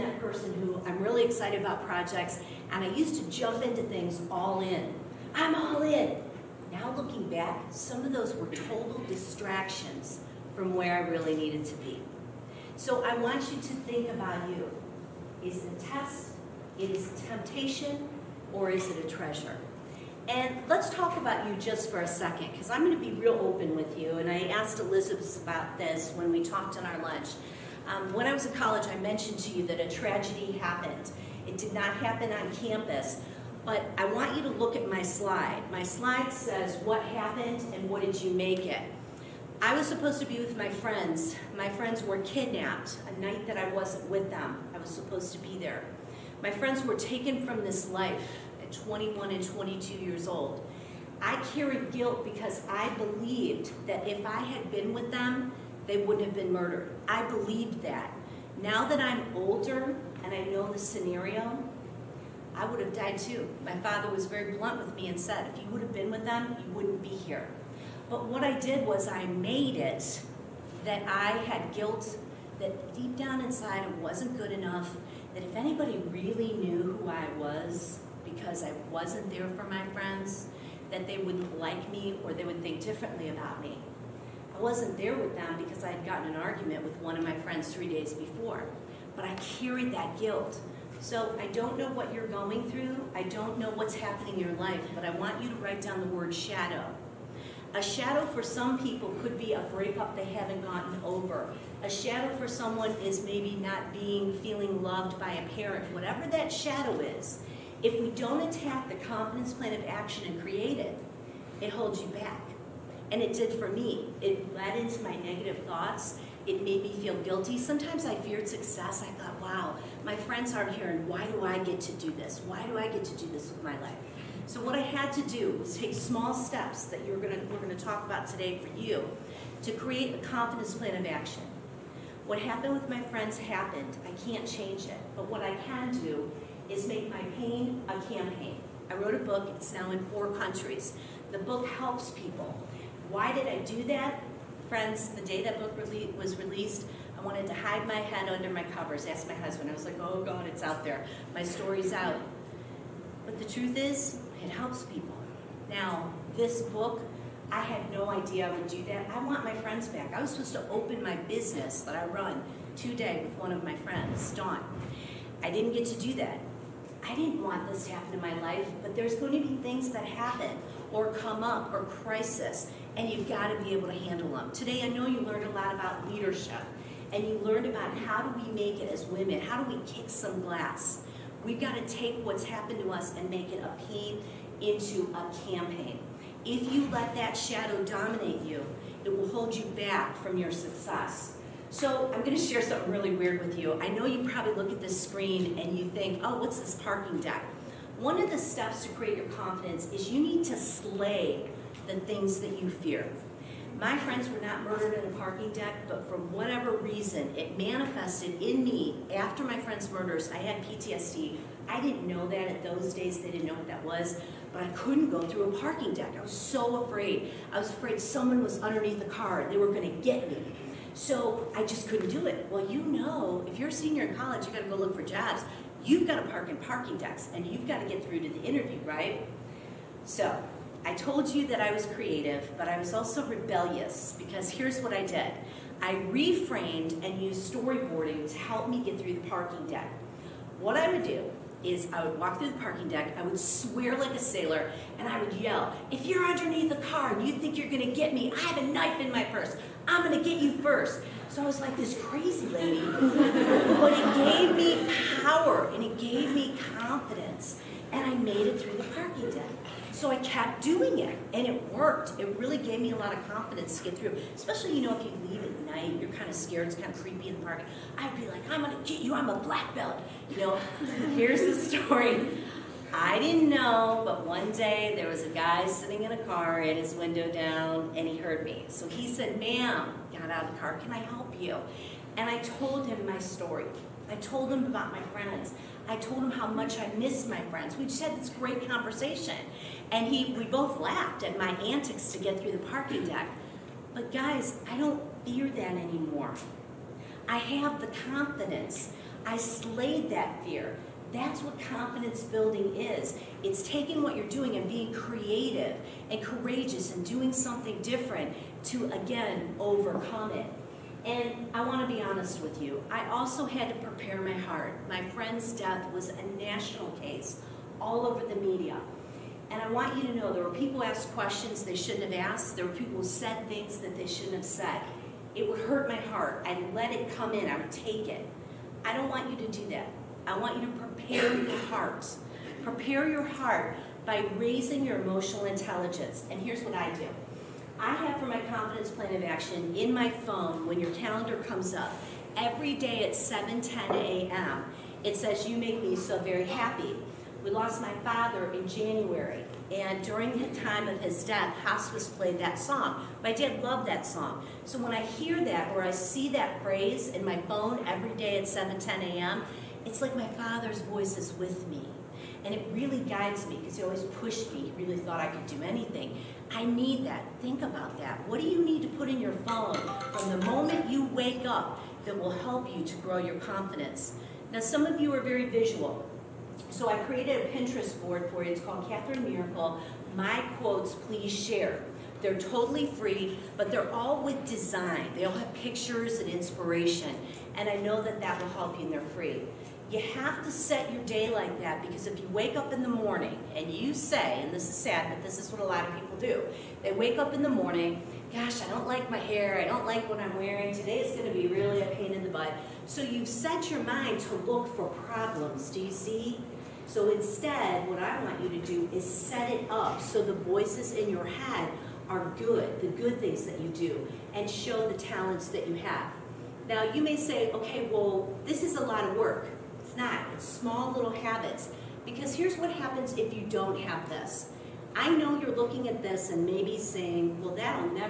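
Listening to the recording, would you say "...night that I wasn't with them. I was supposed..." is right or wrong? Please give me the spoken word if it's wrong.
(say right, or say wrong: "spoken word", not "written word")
right.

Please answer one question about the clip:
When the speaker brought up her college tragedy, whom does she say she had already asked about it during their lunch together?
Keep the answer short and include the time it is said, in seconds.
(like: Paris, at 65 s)
Elizabeth, at 24 s.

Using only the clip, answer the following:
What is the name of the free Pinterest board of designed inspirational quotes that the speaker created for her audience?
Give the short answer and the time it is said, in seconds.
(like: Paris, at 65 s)
Katherine Miracle, at 378 s.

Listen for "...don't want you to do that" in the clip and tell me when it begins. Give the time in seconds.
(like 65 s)
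328 s.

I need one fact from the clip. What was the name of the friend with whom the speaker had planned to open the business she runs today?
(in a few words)
Dawn.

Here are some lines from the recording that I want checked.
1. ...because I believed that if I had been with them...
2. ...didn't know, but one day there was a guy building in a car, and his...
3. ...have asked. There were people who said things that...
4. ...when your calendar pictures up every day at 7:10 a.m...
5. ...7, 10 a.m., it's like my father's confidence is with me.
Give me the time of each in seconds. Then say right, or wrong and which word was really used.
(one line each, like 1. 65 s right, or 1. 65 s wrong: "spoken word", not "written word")
1. 52 s right
2. 273 s wrong: "sitting", not "building"
3. 322 s right
4. 340 s wrong: "comes", not "pictures"
5. 358 s wrong: "voice", not "confidence".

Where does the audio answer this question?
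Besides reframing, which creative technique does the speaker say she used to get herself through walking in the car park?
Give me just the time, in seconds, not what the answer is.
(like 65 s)
237 s.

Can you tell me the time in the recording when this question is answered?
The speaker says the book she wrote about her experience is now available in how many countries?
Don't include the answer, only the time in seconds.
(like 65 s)
140 s.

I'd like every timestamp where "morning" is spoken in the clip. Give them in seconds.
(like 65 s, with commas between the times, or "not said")
392 s, 397 s.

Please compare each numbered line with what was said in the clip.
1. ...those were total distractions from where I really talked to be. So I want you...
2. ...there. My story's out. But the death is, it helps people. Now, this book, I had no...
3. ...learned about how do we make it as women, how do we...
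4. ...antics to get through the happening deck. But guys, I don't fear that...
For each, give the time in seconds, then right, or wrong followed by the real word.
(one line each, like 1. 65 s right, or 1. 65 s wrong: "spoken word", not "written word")
1. 8 s wrong: "needed", not "talked"
2. 150 s wrong: "truth", not "death"
3. 177 s right
4. 291 s wrong: "parking", not "happening".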